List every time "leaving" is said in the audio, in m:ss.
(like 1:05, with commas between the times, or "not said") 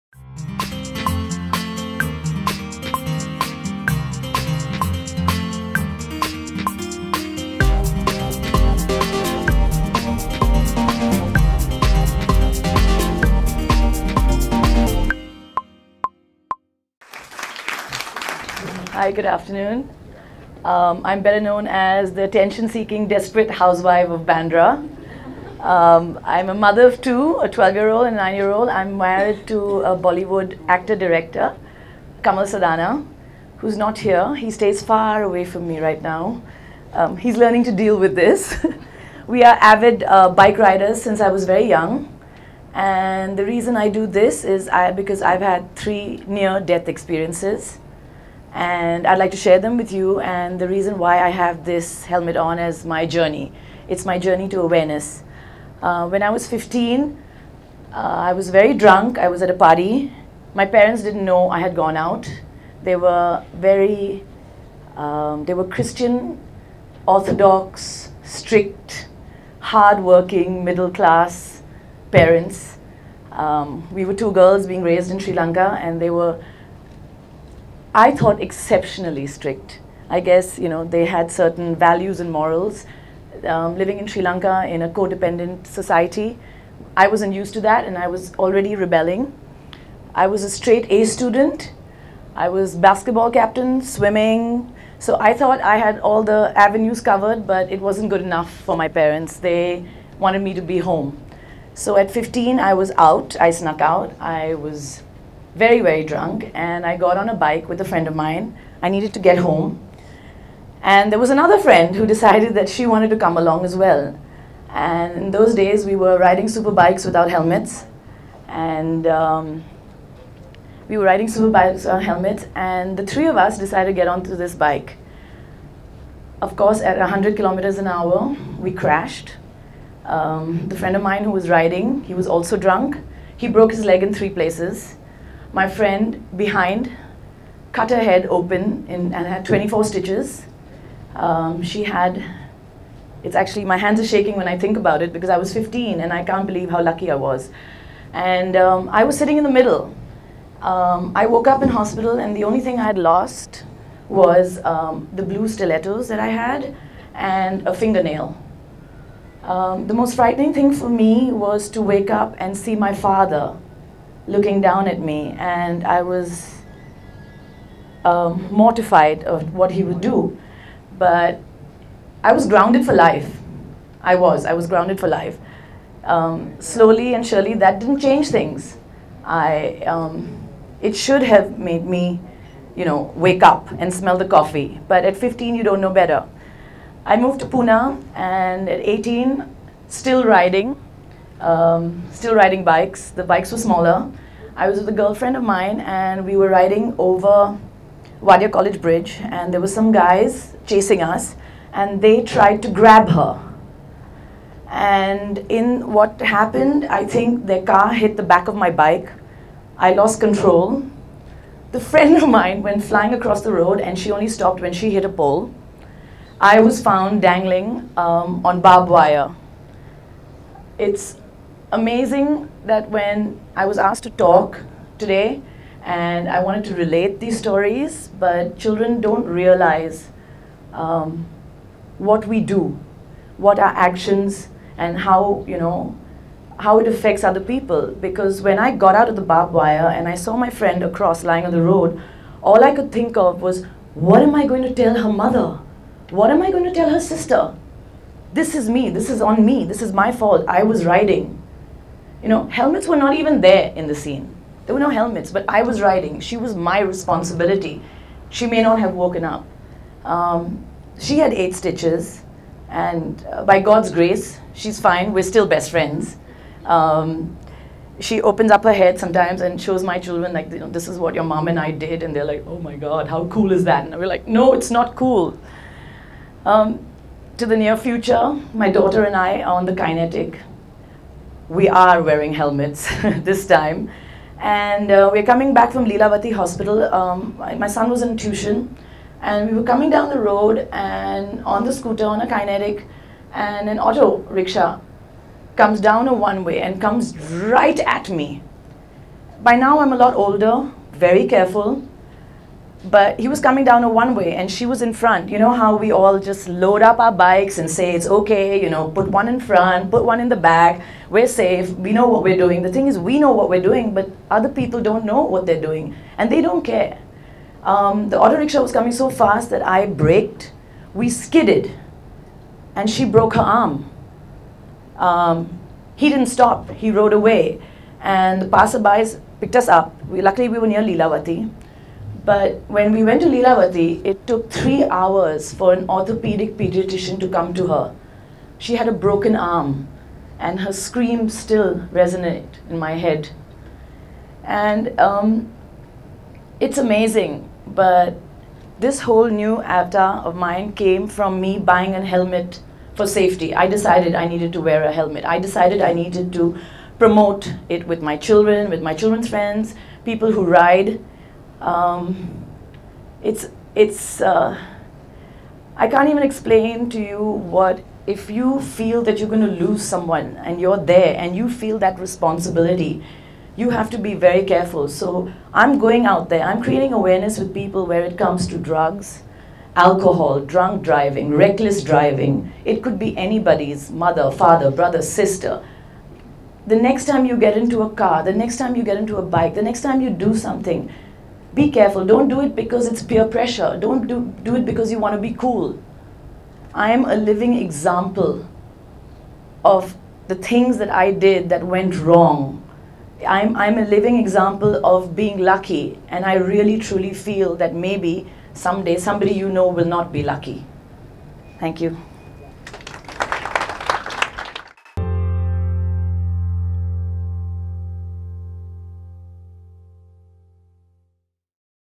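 not said.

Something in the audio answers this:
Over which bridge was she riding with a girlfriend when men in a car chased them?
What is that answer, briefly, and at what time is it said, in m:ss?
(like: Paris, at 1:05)
Wadia College Bridge, at 3:18.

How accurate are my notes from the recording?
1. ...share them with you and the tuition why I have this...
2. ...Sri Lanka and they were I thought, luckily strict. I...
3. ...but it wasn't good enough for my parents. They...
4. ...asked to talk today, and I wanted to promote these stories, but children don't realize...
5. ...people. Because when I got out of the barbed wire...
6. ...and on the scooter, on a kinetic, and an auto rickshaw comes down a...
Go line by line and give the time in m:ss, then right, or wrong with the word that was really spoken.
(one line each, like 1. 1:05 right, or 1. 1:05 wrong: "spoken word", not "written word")
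1. 0:49 wrong: "reason", not "tuition"
2. 1:15 wrong: "exceptionally", not "luckily"
3. 1:37 right
4. 3:43 wrong: "relate", not "promote"
5. 3:57 right
6. 4:50 right.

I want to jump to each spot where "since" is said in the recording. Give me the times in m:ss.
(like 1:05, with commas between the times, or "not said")
0:41.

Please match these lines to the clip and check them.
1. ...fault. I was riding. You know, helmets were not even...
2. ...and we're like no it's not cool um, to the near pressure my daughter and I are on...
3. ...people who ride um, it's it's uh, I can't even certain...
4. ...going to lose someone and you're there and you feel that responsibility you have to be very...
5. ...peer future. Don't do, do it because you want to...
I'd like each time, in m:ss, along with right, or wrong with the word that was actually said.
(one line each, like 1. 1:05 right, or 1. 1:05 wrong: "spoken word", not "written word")
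1. 4:10 right
2. 4:33 wrong: "future", not "pressure"
3. 6:00 wrong: "explain", not "certain"
4. 6:09 right
5. 6:33 wrong: "pressure", not "future".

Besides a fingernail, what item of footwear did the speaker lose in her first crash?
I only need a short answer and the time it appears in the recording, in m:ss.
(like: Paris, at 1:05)
Blue stilettos, at 2:35.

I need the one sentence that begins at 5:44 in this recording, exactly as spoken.
And um, it's amazing, but this whole new avatar of mine came from me buying a helmet for safety.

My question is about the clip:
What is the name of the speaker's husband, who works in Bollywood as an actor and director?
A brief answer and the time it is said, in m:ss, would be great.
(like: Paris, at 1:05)
Kamal Sadanah, at 0:32.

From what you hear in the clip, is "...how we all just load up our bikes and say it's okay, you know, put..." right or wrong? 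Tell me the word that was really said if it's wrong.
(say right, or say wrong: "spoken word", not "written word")
right.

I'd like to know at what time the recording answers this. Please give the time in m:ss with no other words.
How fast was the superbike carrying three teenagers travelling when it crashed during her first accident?
2:06.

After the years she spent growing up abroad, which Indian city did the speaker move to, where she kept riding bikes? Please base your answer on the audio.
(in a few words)
Pune.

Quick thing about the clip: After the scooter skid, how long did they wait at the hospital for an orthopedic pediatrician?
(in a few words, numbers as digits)
3 hours.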